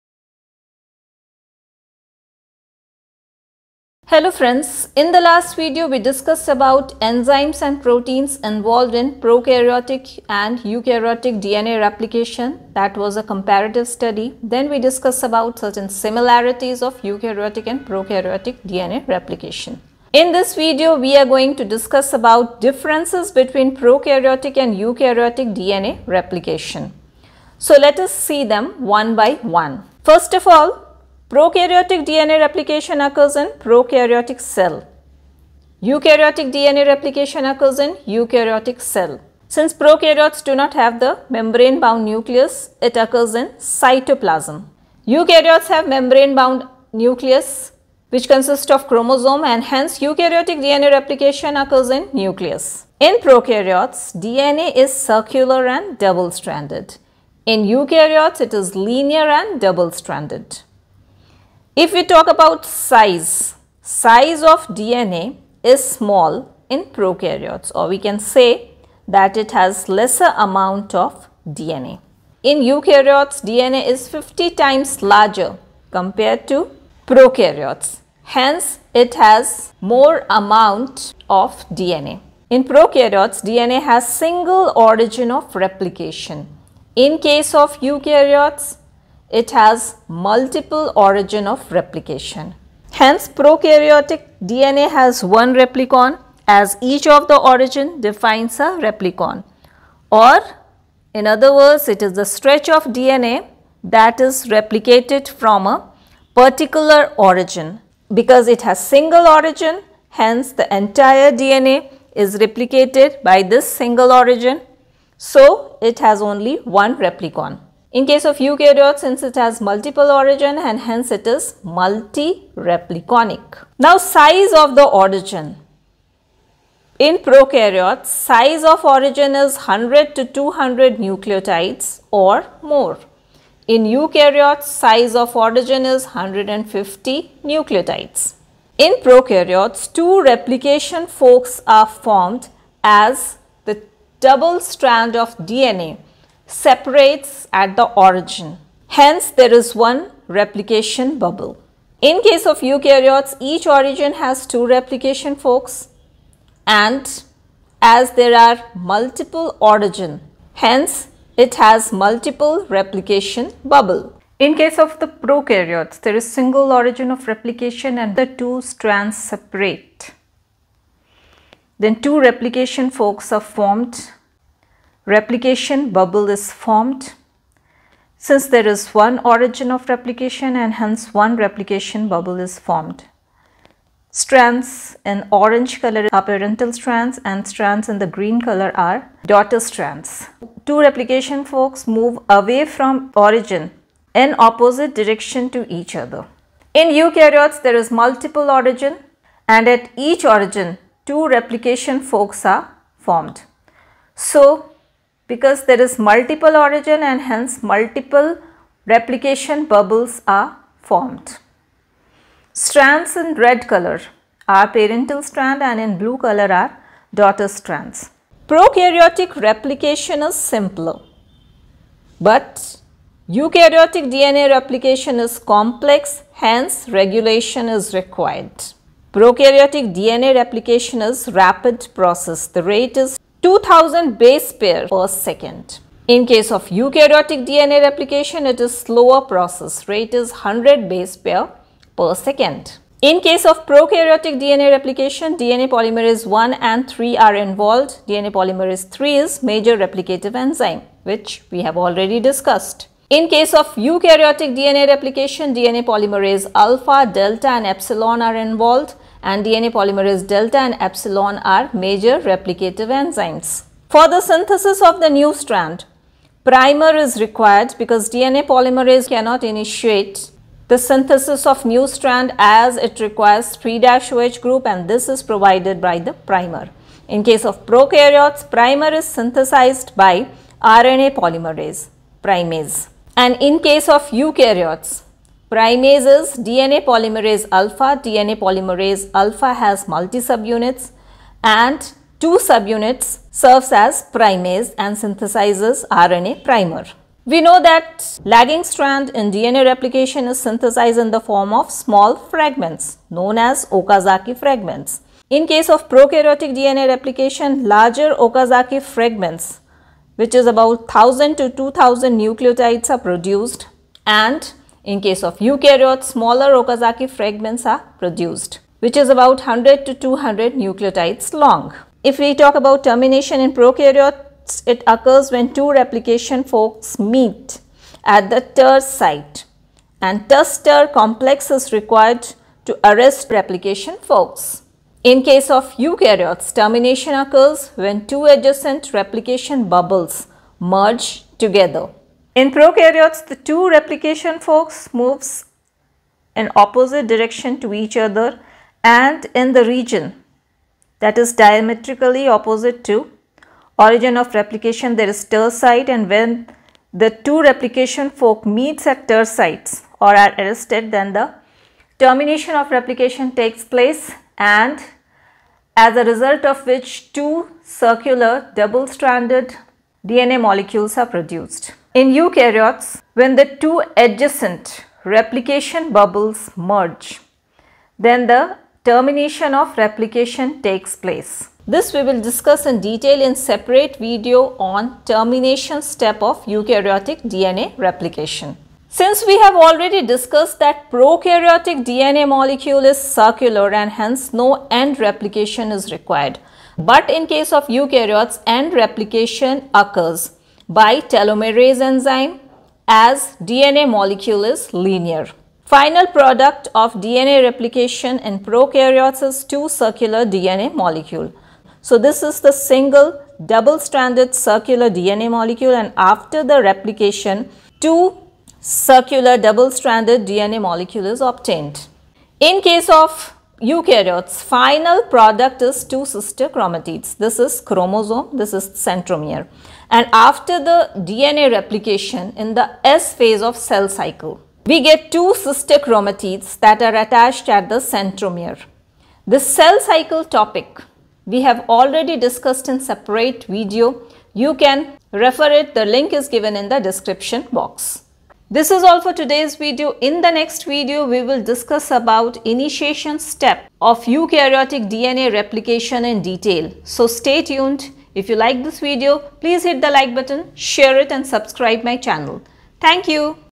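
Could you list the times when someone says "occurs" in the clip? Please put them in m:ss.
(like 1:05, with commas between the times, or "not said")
0:32, 0:37, 0:42, 0:51, 5:24, 5:37, 6:39.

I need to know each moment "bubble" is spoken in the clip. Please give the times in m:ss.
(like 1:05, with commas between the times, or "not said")
2:31, 2:43, 2:55, 3:02, 3:29, 5:39, 6:15.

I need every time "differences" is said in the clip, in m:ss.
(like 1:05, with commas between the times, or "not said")
0:22.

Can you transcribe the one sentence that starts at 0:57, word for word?
In eukaryotes, it is linear and double stranded.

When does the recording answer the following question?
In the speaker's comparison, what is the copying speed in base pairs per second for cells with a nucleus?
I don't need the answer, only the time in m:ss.
4:00.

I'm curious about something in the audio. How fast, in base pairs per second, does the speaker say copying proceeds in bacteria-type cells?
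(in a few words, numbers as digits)
2000.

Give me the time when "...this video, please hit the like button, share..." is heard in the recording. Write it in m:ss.
7:38.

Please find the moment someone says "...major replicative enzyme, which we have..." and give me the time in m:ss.
4:09.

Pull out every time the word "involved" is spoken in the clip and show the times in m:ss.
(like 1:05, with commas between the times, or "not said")
0:08, 4:07, 4:18.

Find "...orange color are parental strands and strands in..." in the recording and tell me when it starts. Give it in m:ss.
3:05.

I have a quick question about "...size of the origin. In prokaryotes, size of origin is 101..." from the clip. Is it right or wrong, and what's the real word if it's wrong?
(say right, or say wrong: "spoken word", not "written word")
wrong: "100", not "101".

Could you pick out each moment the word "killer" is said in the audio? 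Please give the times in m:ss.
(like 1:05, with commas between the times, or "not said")
not said.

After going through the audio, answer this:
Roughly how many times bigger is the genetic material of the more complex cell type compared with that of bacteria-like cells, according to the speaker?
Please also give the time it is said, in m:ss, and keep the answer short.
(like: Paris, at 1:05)
50 times, at 1:14.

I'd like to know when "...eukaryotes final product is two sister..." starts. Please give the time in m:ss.
7:03.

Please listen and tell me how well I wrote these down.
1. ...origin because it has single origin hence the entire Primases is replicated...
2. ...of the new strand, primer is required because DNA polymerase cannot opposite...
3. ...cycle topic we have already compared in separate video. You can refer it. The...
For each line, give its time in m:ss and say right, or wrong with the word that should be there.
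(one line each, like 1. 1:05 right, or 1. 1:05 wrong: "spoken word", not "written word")
1. 1:47 wrong: "DNA", not "Primases"
2. 4:24 wrong: "initiate", not "opposite"
3. 7:19 wrong: "discussed", not "compared".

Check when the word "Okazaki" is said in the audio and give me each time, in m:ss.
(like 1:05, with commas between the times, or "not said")
5:03, 5:08, 5:16.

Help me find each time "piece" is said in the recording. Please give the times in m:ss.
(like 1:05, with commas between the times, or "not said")
not said.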